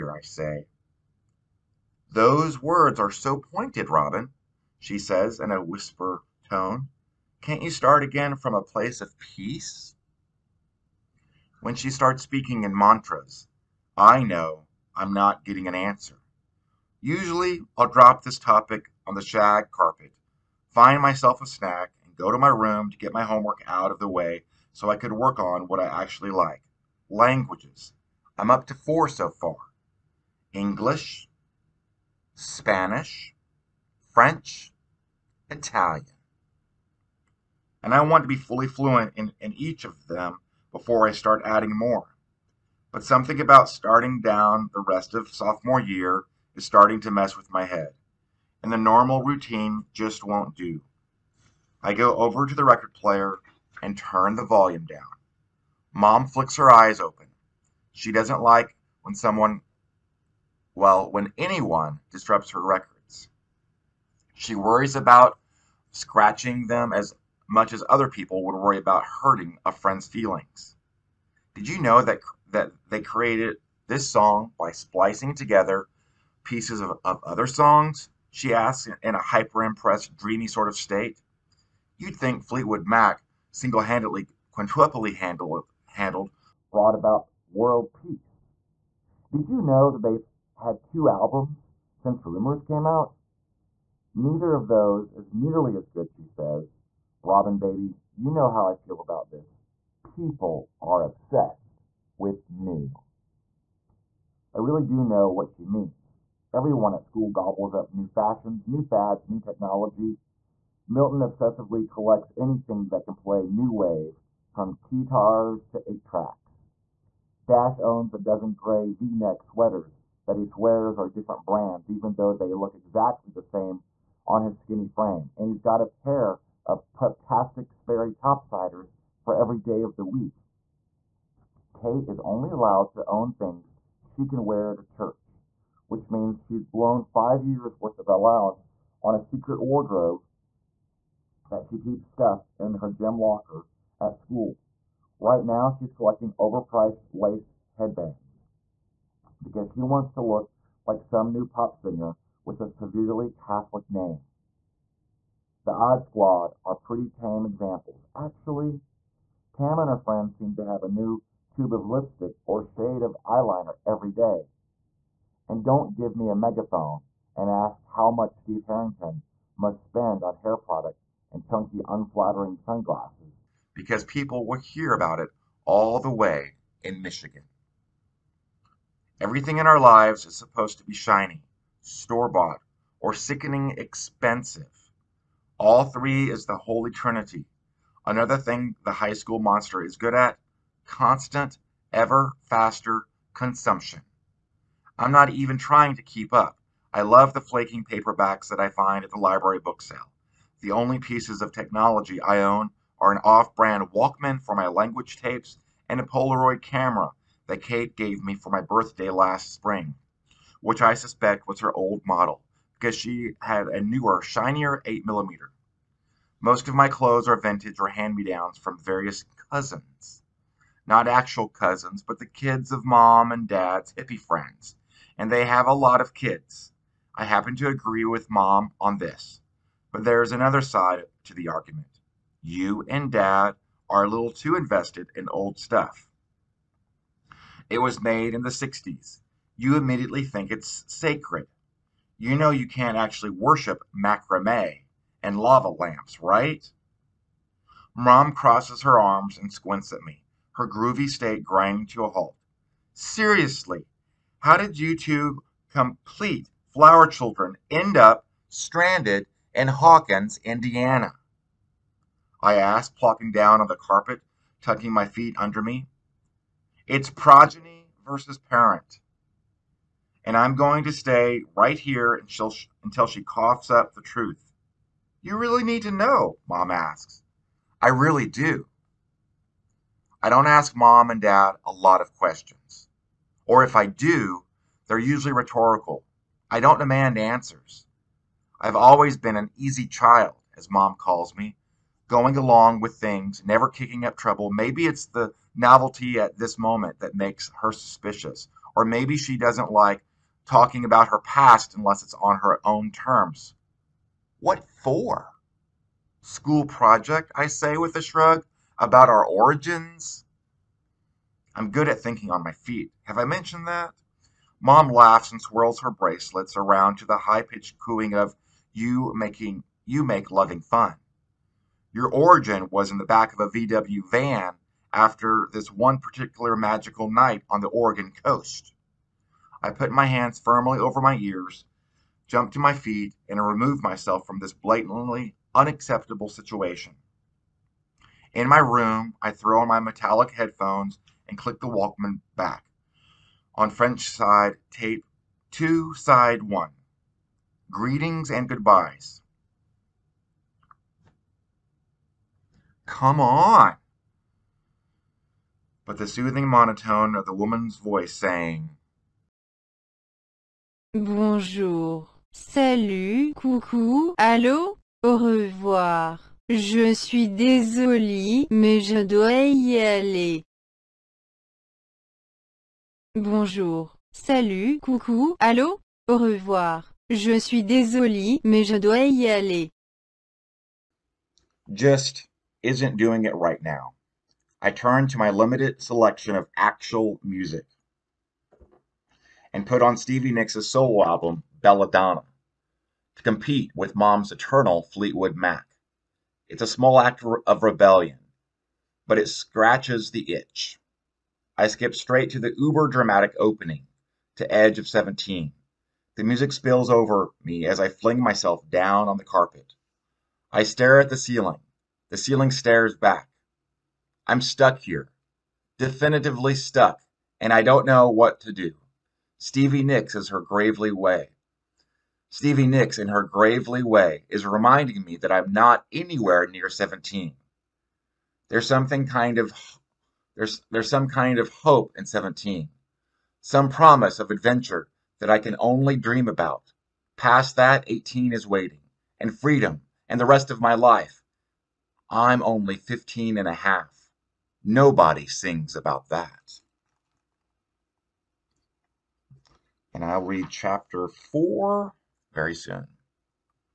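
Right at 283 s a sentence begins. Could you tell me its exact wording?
Or if I do, they're usually rhetorical.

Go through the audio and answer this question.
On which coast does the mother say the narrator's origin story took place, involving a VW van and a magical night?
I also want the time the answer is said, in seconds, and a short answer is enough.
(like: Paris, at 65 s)
Oregon coast, at 327 s.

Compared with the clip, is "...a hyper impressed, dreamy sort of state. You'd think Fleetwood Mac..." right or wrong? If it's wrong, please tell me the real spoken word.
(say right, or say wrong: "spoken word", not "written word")
right.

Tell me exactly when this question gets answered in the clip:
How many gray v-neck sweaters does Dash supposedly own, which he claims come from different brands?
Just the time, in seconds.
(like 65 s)
118 s.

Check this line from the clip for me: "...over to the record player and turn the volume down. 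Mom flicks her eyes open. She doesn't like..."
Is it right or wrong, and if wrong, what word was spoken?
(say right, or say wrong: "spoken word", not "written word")
right.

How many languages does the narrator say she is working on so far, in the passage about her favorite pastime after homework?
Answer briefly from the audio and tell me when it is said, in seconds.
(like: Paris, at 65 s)
4, at 28 s.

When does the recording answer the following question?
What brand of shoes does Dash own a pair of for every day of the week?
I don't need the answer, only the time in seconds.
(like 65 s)
127 s.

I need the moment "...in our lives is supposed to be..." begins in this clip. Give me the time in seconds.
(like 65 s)
179 s.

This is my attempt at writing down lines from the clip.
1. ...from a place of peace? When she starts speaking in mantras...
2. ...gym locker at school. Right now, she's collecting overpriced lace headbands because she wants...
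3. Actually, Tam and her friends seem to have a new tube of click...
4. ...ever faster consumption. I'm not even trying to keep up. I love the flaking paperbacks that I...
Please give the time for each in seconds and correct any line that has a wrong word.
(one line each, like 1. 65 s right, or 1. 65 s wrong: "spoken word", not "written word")
1. 8 s right
2. 142 s right
3. 158 s wrong: "lipstick", not "click"
4. 191 s right.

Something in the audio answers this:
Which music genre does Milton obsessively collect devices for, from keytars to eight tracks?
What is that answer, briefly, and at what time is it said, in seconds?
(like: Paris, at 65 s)
new wave, at 113 s.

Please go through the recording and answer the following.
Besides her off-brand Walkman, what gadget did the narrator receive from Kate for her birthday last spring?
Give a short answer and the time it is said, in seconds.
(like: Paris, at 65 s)
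Polaroid camera, at 206 s.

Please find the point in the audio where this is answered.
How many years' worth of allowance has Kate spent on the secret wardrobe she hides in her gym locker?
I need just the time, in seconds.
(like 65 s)
137 s.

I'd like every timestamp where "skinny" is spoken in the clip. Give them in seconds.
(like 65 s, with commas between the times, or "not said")
124 s.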